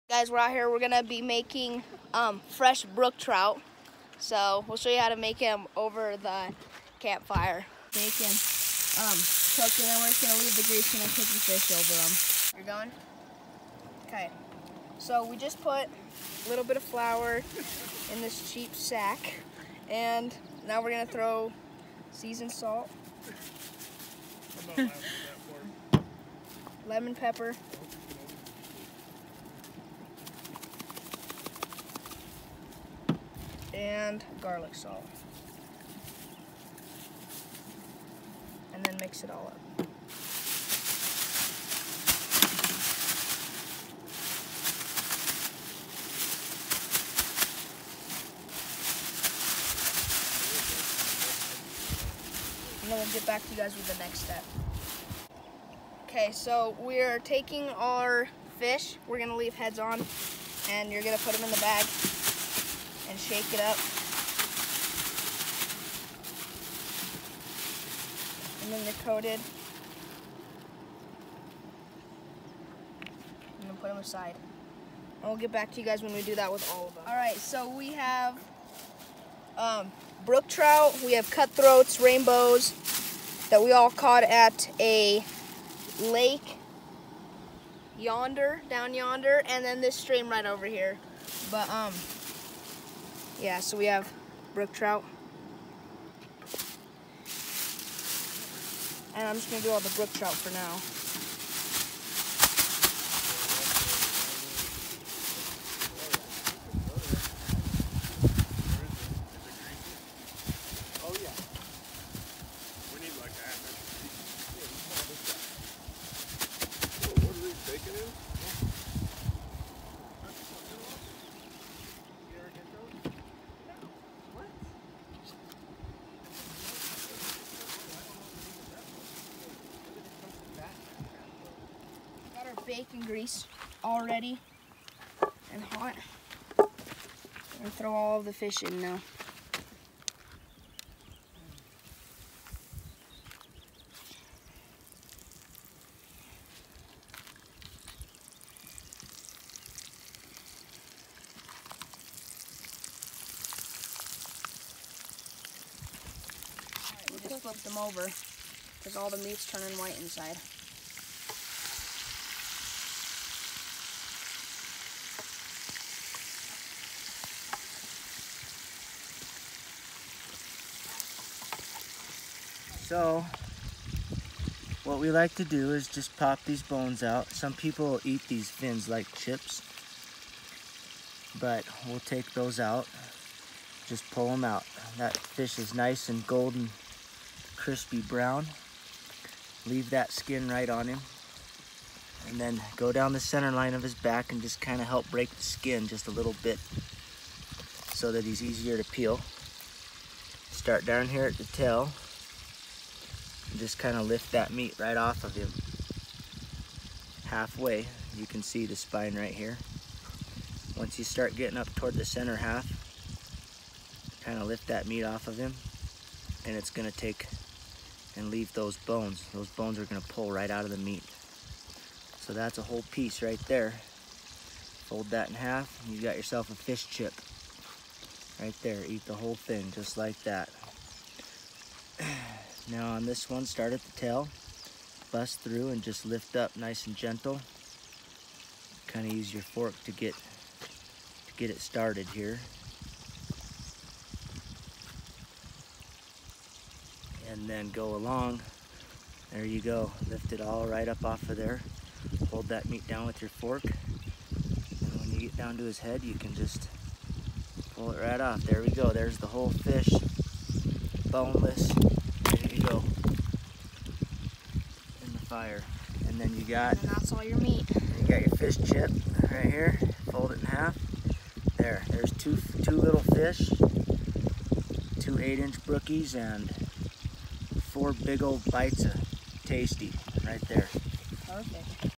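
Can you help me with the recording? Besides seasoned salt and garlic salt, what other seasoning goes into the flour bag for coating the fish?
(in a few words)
lemon pepper.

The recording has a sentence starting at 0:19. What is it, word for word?
And now we're going to throw seasoned salt.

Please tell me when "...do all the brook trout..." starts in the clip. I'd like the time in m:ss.
1:39.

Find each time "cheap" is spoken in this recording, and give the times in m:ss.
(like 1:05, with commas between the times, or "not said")
0:18.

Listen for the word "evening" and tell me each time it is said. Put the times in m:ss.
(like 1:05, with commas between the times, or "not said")
not said.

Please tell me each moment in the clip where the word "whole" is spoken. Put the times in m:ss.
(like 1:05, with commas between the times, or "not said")
3:42, 3:49, 4:19.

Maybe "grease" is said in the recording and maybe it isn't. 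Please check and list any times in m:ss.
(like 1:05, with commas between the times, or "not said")
0:10, 2:13.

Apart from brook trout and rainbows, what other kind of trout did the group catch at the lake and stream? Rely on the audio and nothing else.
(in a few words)
cutthroats.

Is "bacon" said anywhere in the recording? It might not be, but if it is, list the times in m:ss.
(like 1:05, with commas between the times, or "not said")
0:07, 2:12.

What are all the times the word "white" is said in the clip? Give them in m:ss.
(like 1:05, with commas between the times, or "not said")
2:39.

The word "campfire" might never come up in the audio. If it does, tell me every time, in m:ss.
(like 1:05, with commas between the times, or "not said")
0:06.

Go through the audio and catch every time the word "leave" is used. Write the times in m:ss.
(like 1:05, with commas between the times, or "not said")
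0:10, 0:59, 3:09, 3:38.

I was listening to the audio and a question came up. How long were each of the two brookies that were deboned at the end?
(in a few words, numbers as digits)
8 inches.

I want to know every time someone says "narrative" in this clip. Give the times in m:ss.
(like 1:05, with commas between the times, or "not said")
not said.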